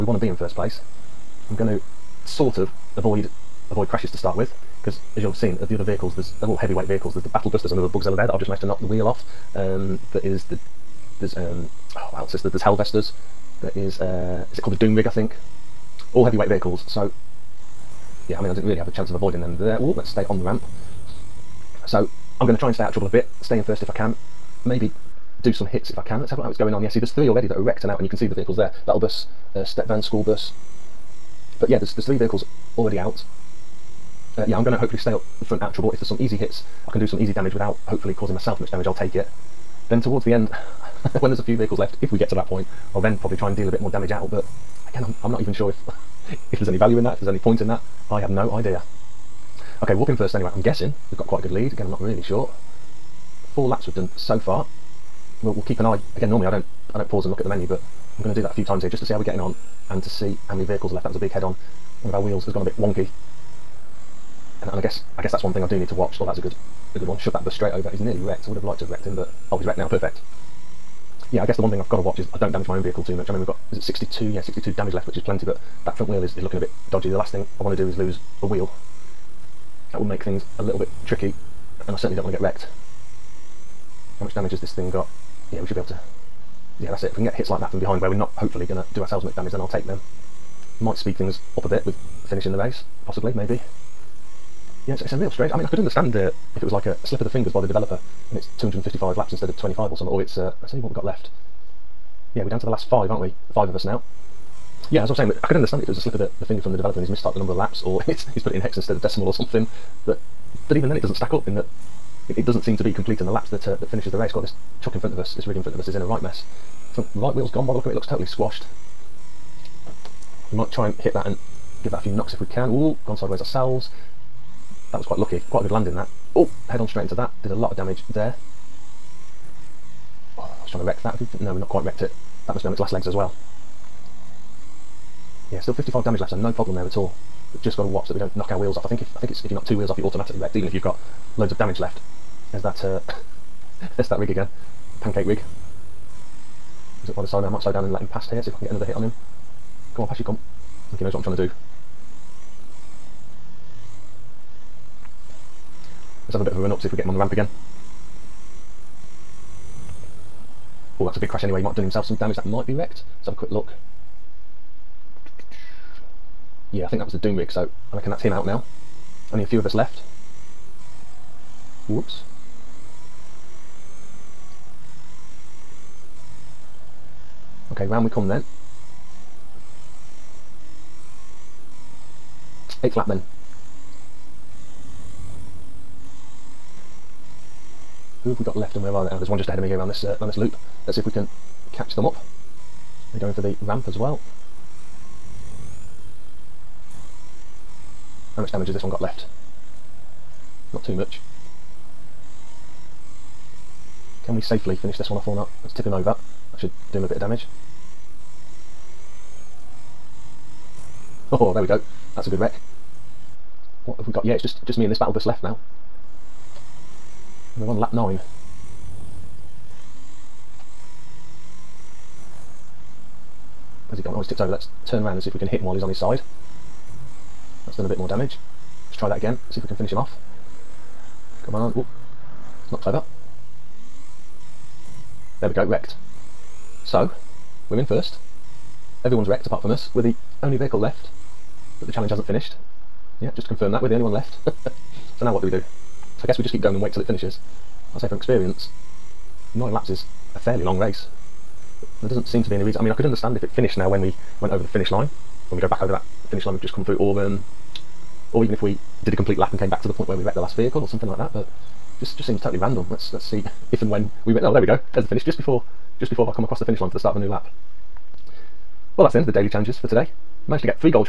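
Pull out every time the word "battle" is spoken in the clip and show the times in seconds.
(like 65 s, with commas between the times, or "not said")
7 s, 28 s, 214 s.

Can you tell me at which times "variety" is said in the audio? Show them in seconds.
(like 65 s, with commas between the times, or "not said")
not said.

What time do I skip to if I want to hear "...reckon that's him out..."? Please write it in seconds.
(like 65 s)
167 s.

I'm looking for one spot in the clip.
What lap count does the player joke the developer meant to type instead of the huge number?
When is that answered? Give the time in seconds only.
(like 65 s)
99 s.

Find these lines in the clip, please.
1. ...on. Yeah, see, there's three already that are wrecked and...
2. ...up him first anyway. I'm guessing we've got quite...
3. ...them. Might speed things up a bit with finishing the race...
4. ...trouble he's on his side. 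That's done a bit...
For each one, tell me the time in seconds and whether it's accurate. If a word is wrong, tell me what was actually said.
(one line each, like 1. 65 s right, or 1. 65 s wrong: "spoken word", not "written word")
1. 26 s right
2. 50 s right
3. 89 s right
4. 225 s wrong: "while", not "trouble".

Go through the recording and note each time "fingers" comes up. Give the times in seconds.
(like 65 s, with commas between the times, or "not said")
97 s, 106 s.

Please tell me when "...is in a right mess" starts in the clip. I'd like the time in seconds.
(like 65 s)
115 s.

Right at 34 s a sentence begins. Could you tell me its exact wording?
Uh, yeah, I'm gonna hopefully stay up the front out of trouble.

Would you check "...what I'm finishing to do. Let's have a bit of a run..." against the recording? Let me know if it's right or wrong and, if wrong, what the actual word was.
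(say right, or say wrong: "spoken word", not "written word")
wrong: "trying", not "finishing".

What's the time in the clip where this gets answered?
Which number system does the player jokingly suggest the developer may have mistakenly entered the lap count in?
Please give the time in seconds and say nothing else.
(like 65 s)
108 s.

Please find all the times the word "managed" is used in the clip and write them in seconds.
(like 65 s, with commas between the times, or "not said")
8 s, 270 s.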